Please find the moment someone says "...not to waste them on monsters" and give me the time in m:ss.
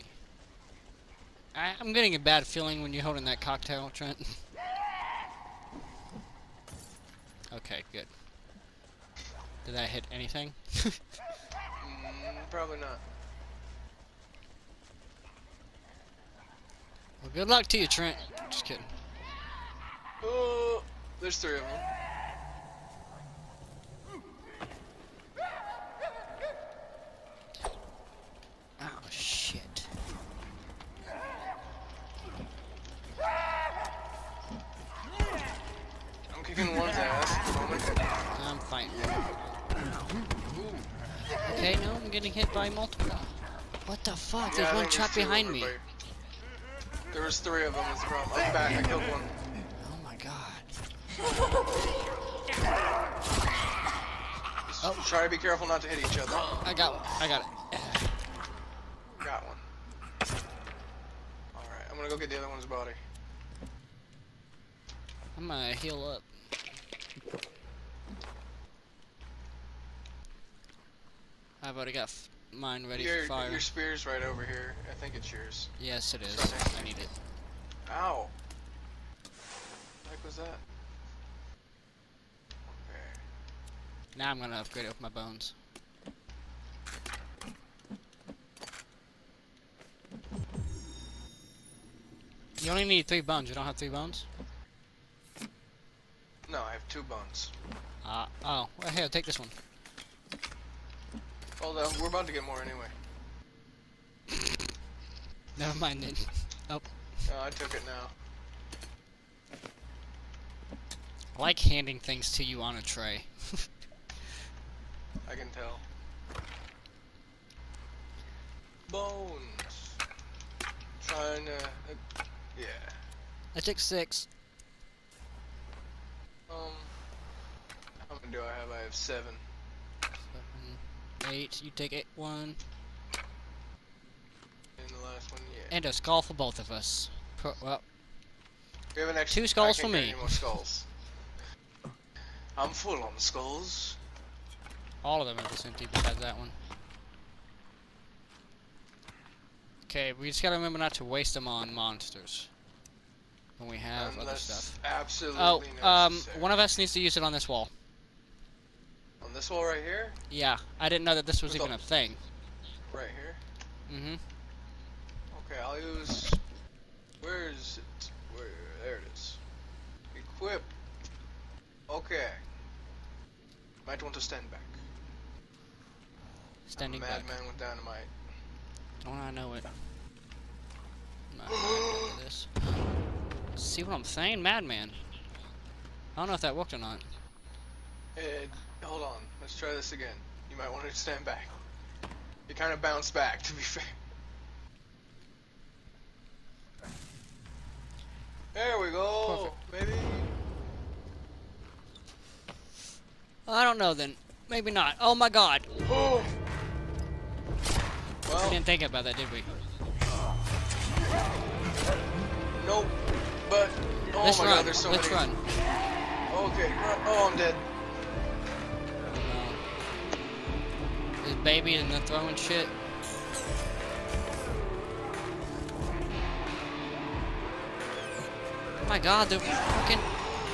2:30.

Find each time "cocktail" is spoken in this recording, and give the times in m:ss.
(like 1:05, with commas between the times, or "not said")
0:03.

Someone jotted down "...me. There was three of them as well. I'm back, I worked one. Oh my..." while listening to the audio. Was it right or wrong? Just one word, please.
wrong.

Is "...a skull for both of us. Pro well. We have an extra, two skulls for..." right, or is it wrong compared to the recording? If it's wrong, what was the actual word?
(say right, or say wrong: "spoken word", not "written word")
right.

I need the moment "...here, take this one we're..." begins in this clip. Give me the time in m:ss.
1:38.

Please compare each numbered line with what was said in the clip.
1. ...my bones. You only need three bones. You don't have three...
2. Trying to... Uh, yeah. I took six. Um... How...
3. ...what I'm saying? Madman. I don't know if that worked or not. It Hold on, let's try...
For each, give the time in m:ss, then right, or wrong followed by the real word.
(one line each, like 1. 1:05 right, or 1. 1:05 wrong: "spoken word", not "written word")
1. 1:24 right
2. 2:01 right
3. 3:03 right.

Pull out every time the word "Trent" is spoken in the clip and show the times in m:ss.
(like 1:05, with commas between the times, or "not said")
0:03, 0:17.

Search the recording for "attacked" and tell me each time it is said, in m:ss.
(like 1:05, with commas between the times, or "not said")
not said.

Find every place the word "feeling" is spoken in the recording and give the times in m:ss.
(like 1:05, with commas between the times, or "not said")
0:02.